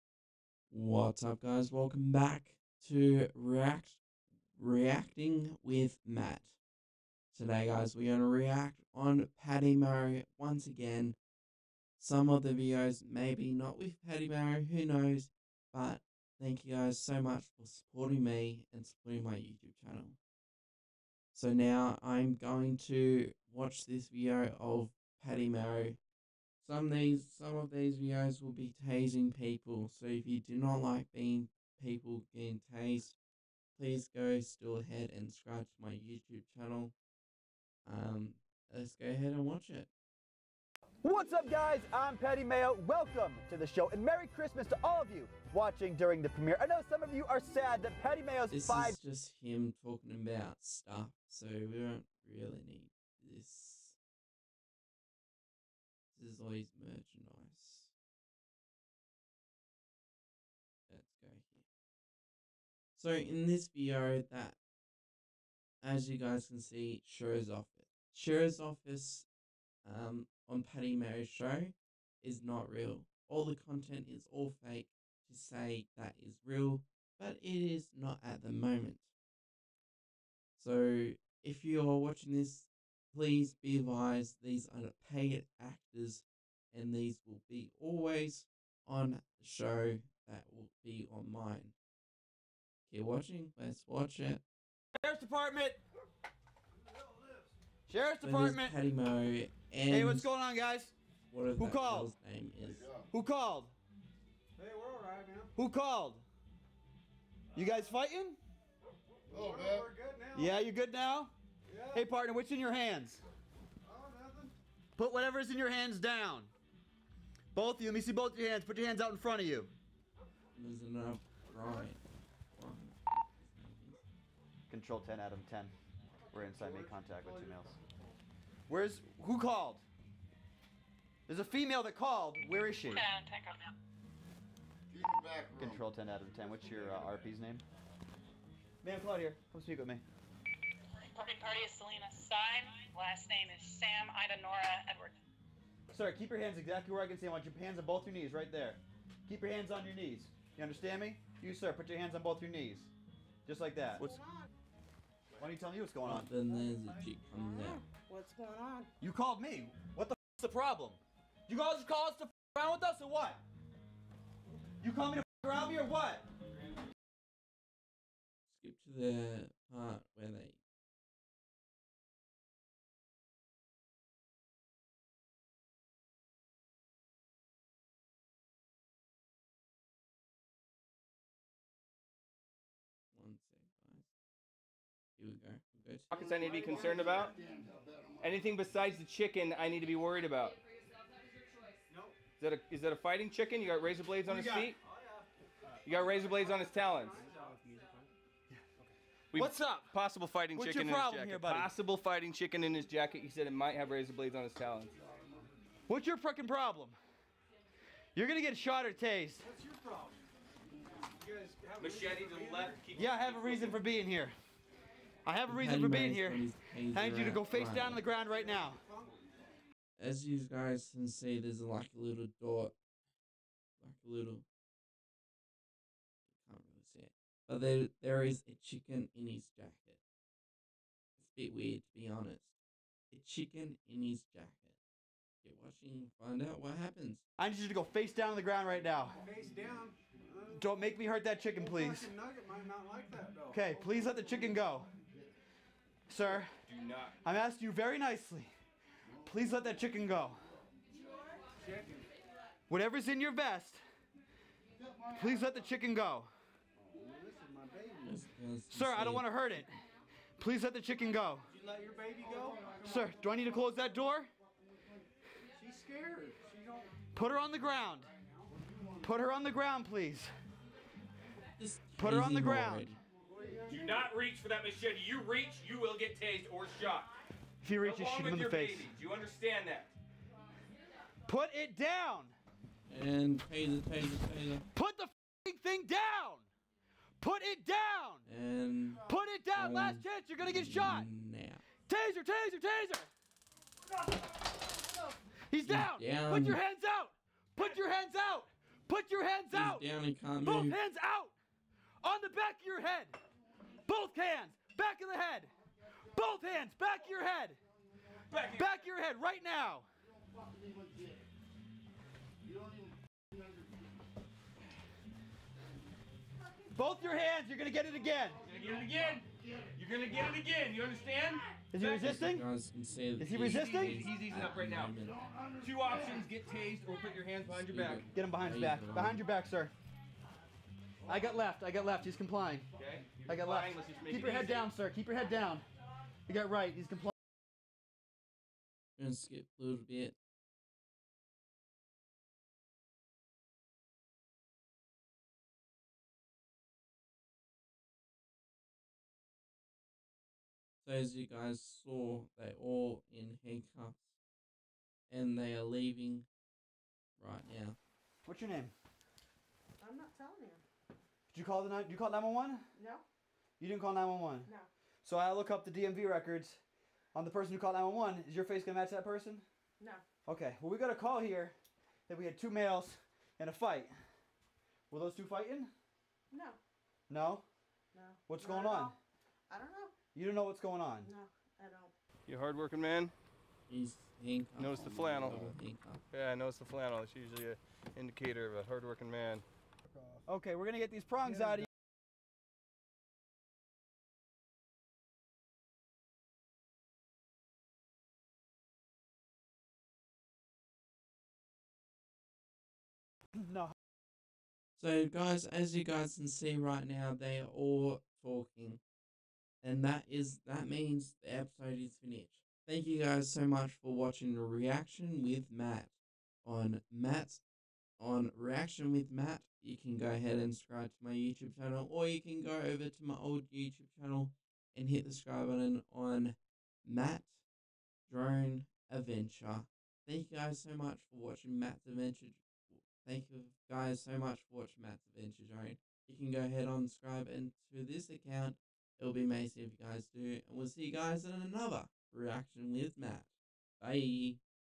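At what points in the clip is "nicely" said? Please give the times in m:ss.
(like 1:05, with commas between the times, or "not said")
4:07.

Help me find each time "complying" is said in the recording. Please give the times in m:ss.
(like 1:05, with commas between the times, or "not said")
5:32, 5:36.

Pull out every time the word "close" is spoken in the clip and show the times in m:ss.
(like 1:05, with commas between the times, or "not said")
4:23.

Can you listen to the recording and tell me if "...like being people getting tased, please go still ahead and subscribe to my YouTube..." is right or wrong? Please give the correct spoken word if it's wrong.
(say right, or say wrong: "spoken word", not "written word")
right.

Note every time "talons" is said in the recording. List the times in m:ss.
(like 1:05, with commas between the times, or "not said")
3:16, 3:24.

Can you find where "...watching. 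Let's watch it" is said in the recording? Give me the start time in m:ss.
1:33.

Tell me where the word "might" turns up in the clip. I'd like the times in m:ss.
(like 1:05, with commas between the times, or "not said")
3:23.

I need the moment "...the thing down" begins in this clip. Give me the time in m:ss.
4:44.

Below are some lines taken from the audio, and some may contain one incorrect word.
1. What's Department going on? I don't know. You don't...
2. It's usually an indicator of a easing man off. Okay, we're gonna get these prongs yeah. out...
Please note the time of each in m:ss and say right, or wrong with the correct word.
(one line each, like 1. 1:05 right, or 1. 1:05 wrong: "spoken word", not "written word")
1. 6:18 wrong: "Not", not "Department"
2. 6:26 wrong: "hardworking", not "easing".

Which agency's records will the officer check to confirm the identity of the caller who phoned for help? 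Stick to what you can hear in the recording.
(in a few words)
DMV.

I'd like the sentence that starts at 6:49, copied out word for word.
And that is that means the episode is finished.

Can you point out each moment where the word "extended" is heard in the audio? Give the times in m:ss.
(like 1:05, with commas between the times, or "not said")
not said.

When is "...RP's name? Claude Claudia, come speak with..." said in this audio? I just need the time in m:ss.
2:17.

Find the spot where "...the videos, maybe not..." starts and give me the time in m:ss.
0:12.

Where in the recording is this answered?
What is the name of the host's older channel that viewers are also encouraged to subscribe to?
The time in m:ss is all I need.
7:06.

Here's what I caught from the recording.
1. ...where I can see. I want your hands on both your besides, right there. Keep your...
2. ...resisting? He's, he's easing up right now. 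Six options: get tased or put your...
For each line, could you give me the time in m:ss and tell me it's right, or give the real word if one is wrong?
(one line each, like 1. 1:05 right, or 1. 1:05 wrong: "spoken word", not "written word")
1. 2:26 wrong: "knees", not "besides"
2. 5:23 wrong: "Two", not "Six".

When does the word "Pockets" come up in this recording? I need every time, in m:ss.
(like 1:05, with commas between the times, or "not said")
3:06.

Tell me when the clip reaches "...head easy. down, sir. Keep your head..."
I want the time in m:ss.
5:34.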